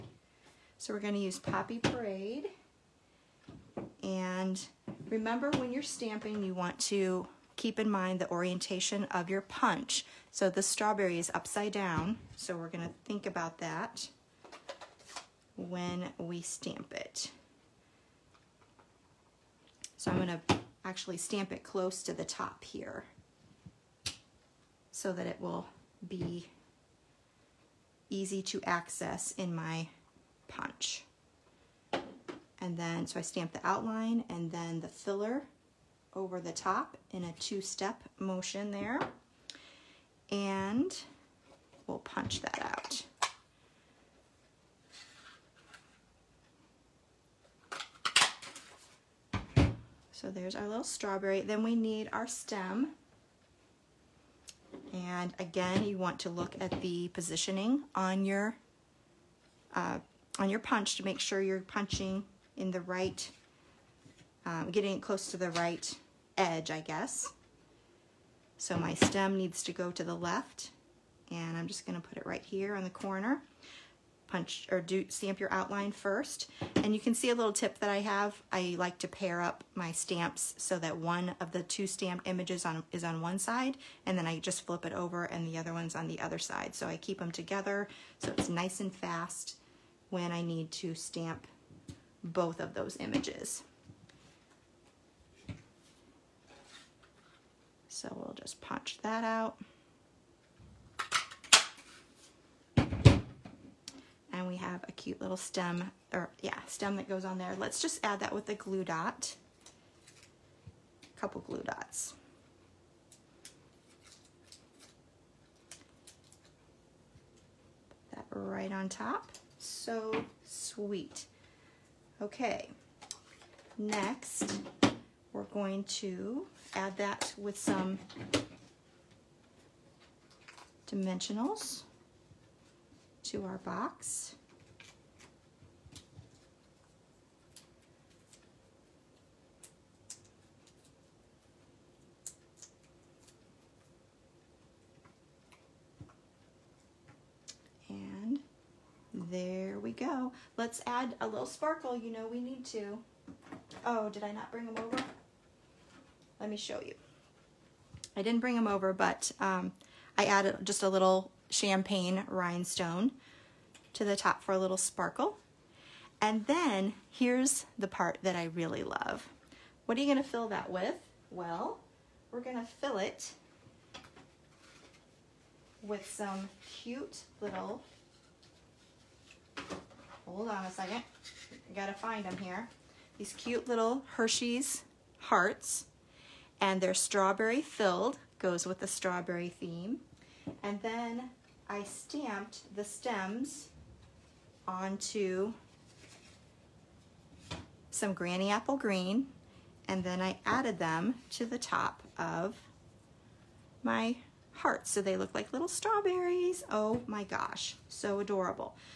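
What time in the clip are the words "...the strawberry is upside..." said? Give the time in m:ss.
0:10.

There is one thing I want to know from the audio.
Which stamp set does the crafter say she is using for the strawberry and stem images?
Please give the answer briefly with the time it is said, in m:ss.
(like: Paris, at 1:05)
Poppy Parade, at 0:01.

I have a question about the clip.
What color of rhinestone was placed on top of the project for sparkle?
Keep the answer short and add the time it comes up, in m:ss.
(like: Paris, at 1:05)
Champagne, at 2:41.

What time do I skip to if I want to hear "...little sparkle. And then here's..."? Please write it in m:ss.
2:44.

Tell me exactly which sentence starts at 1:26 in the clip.
So I keep them together so it's nice and fast when I need to stamp both of those images.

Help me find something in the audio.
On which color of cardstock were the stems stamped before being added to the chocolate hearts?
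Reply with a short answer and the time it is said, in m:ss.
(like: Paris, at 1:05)
Granny Apple Green, at 3:18.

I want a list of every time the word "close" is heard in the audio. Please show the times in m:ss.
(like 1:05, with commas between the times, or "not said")
0:21, 1:05.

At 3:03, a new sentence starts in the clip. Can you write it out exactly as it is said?
These cute little Hershey's hearts and they're strawberry filled, goes with the strawberry theme.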